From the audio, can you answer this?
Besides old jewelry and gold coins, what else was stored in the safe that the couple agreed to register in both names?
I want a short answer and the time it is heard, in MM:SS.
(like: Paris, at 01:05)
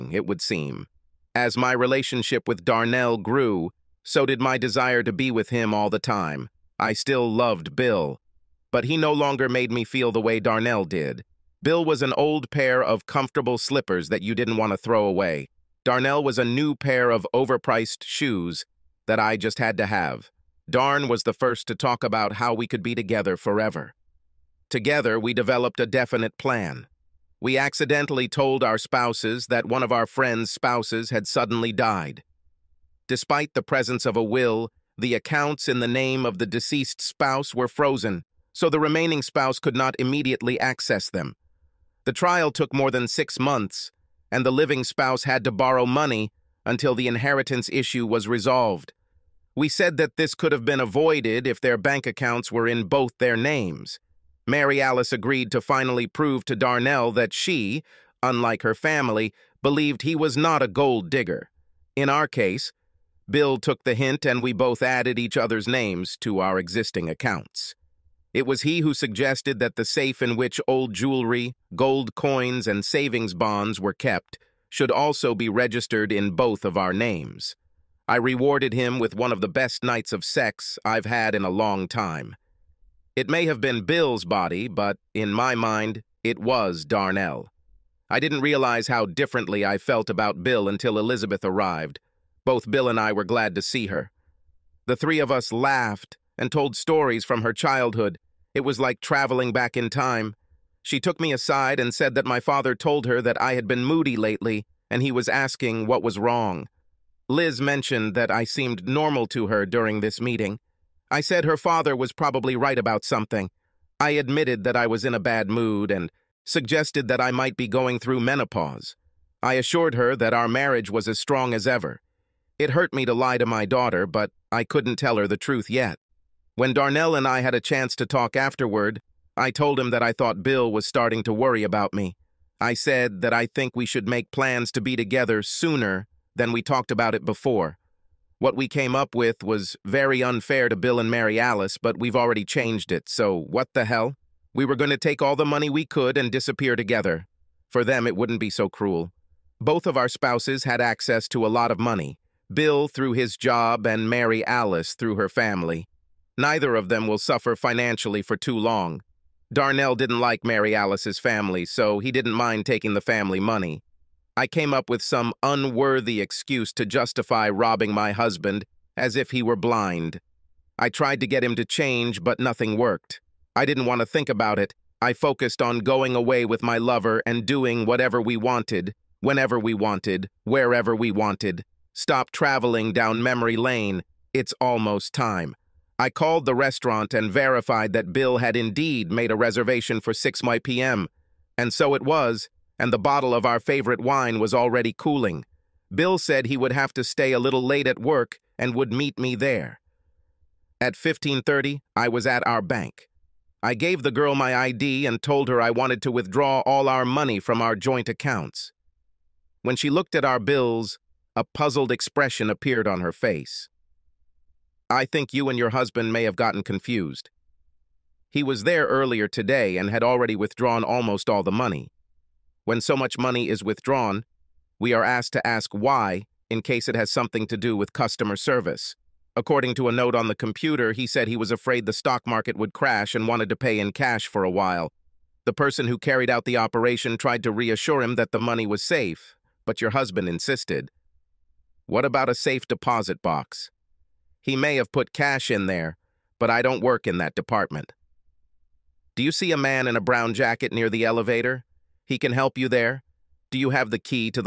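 savings bonds, at 01:12.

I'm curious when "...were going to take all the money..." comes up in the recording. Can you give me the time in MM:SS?
02:24.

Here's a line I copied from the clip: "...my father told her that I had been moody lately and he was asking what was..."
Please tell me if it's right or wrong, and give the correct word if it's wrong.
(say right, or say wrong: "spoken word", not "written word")
right.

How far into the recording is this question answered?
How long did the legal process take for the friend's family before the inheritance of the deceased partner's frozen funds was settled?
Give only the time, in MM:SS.
00:42.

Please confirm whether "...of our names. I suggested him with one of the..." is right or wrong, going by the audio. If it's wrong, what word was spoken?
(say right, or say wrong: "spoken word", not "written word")
wrong: "rewarded", not "suggested".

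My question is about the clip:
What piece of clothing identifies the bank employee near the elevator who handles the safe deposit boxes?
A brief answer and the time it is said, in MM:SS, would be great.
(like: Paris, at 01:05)
brown jacket, at 04:10.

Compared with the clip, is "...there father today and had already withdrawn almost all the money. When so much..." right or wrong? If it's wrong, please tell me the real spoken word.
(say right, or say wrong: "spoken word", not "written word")
wrong: "earlier", not "father".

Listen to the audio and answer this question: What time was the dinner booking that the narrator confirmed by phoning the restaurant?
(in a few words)
6 p.m.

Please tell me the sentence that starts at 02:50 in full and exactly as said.
I tried to get him to change, but nothing worked.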